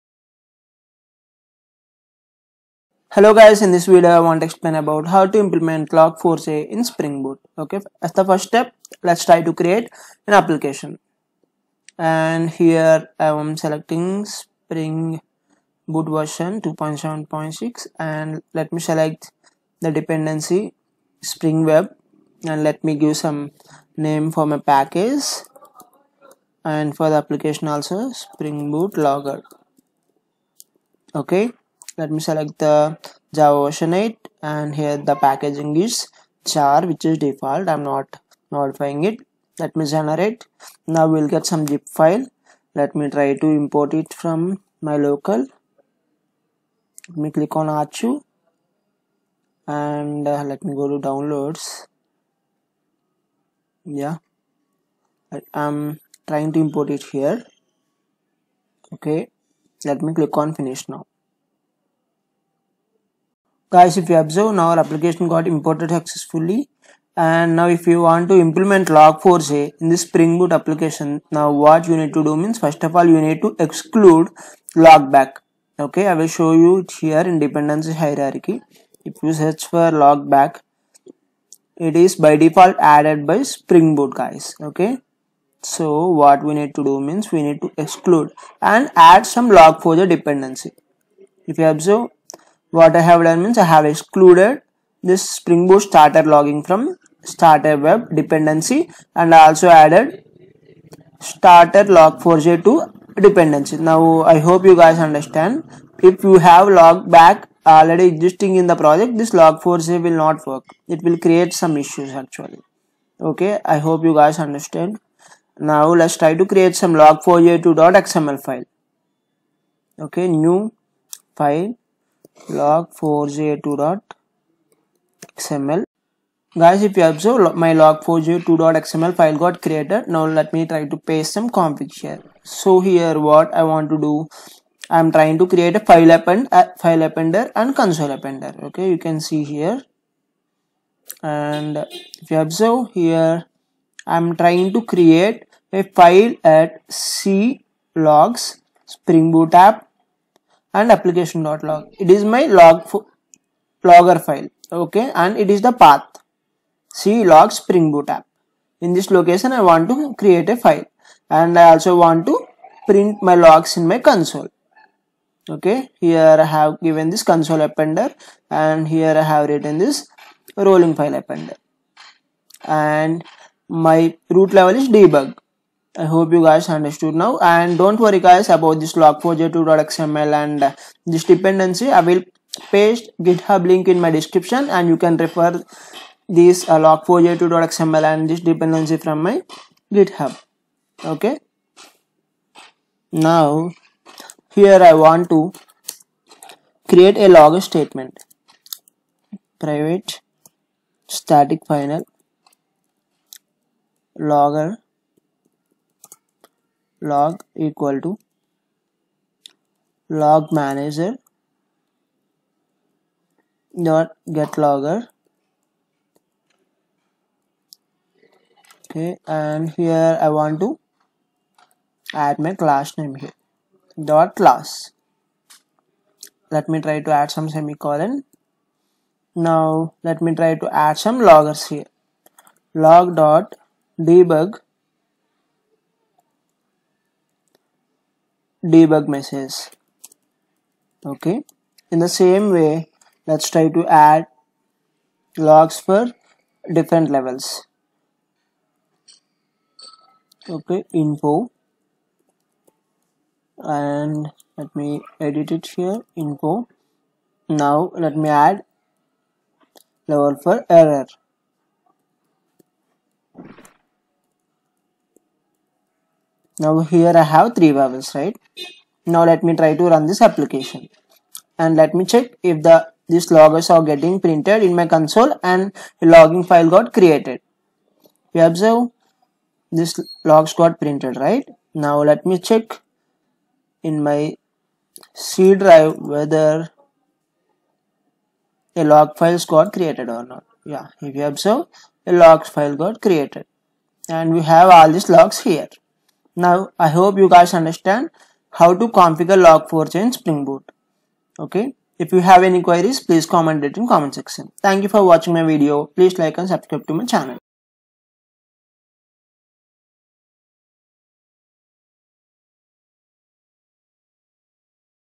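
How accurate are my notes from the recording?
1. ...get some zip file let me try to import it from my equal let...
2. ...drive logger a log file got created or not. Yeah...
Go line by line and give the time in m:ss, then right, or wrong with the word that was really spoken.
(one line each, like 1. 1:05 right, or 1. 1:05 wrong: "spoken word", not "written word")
1. 0:41 wrong: "local", not "equal"
2. 4:45 wrong: "whether", not "logger".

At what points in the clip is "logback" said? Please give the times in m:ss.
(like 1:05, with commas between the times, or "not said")
1:14, 1:20, 1:46.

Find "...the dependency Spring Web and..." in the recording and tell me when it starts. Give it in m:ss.
0:19.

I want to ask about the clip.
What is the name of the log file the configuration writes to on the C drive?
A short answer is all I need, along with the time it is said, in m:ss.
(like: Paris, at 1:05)
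application.log, at 2:30.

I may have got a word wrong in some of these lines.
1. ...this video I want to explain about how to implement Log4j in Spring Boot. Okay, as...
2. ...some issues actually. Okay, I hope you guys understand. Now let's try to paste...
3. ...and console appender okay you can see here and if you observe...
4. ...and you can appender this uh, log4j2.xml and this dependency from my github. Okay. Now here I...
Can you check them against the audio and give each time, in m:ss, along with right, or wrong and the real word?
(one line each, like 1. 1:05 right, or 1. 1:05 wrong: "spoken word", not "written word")
1. 0:03 right
2. 1:51 wrong: "create", not "paste"
3. 2:17 right
4. 3:04 wrong: "refer", not "appender".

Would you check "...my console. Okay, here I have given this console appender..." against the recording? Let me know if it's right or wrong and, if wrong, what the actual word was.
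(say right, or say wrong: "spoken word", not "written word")
right.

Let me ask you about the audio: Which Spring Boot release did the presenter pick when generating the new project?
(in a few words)
2.7.6.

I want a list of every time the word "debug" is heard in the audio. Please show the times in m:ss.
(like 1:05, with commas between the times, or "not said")
2:54, 3:53, 3:58.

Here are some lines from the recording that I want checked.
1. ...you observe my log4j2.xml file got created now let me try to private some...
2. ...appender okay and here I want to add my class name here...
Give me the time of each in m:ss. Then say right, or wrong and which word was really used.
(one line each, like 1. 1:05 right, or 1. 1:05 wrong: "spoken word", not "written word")
1. 2:06 wrong: "paste", not "private"
2. 3:34 wrong: "logger", not "appender".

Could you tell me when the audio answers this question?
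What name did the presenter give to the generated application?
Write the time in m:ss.
0:28.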